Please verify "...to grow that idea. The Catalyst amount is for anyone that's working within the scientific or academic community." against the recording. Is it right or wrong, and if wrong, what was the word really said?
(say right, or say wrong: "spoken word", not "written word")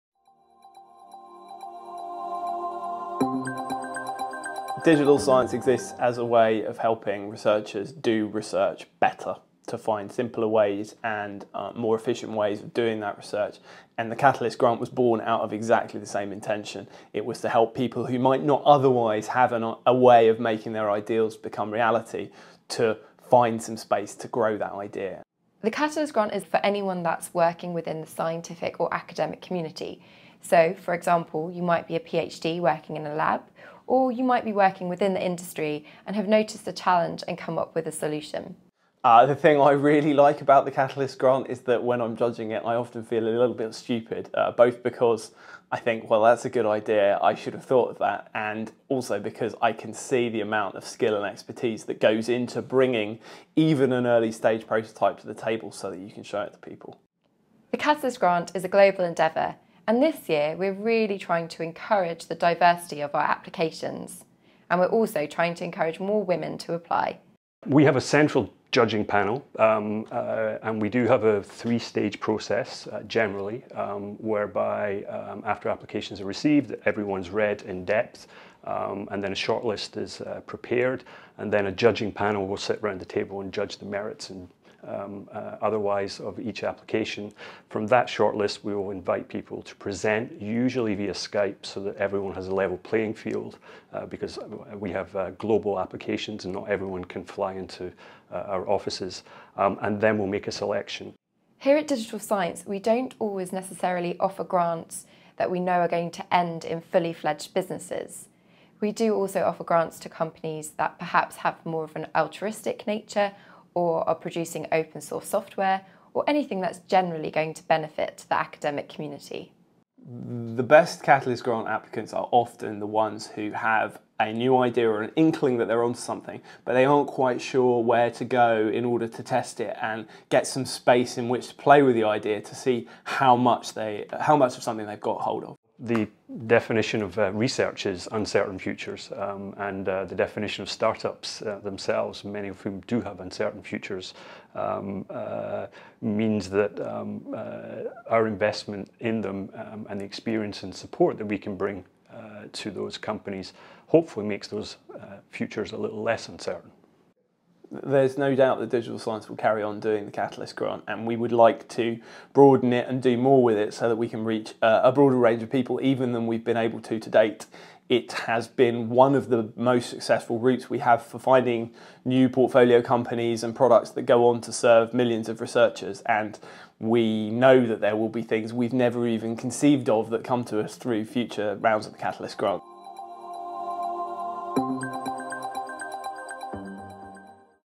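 wrong: "grant", not "amount".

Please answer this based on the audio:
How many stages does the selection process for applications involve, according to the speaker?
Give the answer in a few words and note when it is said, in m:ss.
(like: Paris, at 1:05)
3, at 1:11.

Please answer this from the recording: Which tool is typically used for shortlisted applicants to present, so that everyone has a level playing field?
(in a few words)
Skype.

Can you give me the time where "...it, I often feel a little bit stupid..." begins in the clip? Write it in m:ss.
0:42.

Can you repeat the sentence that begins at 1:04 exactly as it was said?
And we're also trying to encourage more women to apply.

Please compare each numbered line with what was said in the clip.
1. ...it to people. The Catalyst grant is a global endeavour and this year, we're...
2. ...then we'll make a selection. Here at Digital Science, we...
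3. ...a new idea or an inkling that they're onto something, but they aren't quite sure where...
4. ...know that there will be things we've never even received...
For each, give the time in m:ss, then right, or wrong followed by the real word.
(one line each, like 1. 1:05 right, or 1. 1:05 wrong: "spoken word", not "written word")
1. 0:56 right
2. 1:39 right
3. 2:04 right
4. 2:57 wrong: "conceived", not "received".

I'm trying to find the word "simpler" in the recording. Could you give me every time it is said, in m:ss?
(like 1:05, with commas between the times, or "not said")
0:10.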